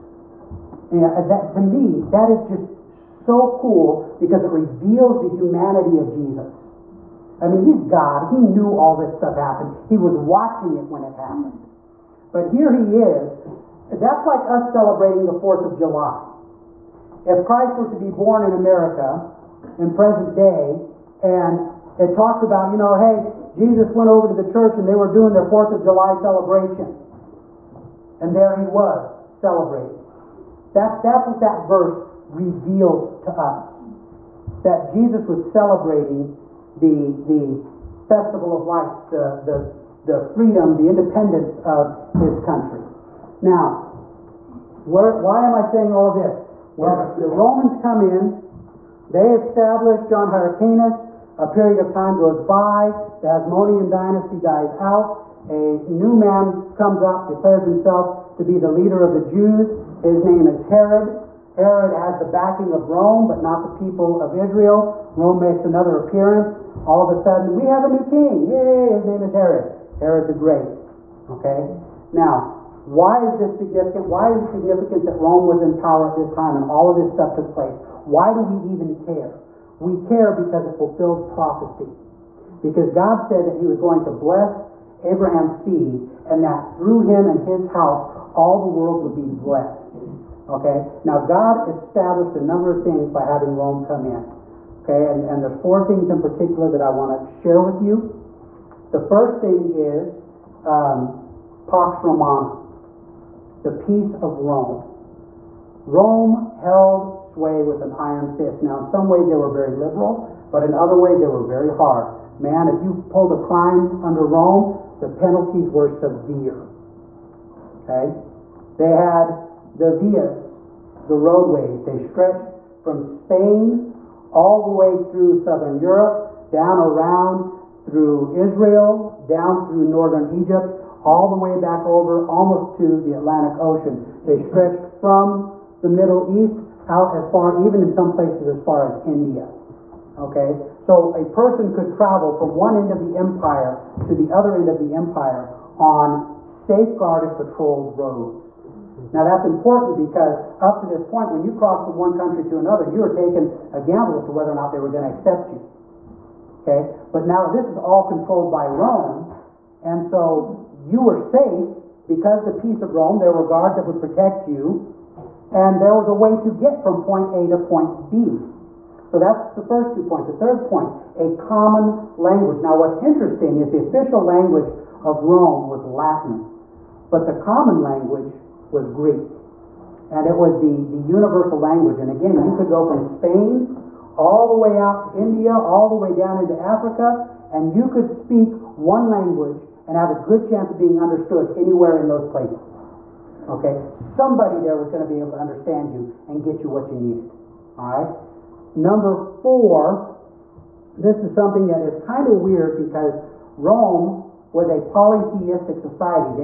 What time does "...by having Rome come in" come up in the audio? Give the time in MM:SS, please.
01:33.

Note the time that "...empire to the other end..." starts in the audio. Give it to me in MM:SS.
02:23.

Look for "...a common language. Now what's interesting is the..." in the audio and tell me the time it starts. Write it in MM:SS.
02:51.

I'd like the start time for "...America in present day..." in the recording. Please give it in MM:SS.
00:18.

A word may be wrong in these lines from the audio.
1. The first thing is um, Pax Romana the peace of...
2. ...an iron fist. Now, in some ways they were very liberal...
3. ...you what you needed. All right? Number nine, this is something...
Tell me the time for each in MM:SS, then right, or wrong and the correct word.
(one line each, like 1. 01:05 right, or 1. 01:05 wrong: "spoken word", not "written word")
1. 01:38 right
2. 01:47 right
3. 03:16 wrong: "four", not "nine".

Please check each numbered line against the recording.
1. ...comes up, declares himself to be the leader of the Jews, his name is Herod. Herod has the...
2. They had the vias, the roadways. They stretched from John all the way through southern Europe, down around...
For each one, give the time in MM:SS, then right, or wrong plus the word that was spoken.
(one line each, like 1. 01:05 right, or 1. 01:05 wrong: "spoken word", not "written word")
1. 00:56 right
2. 01:58 wrong: "Spain", not "John".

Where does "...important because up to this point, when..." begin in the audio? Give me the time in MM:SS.
02:29.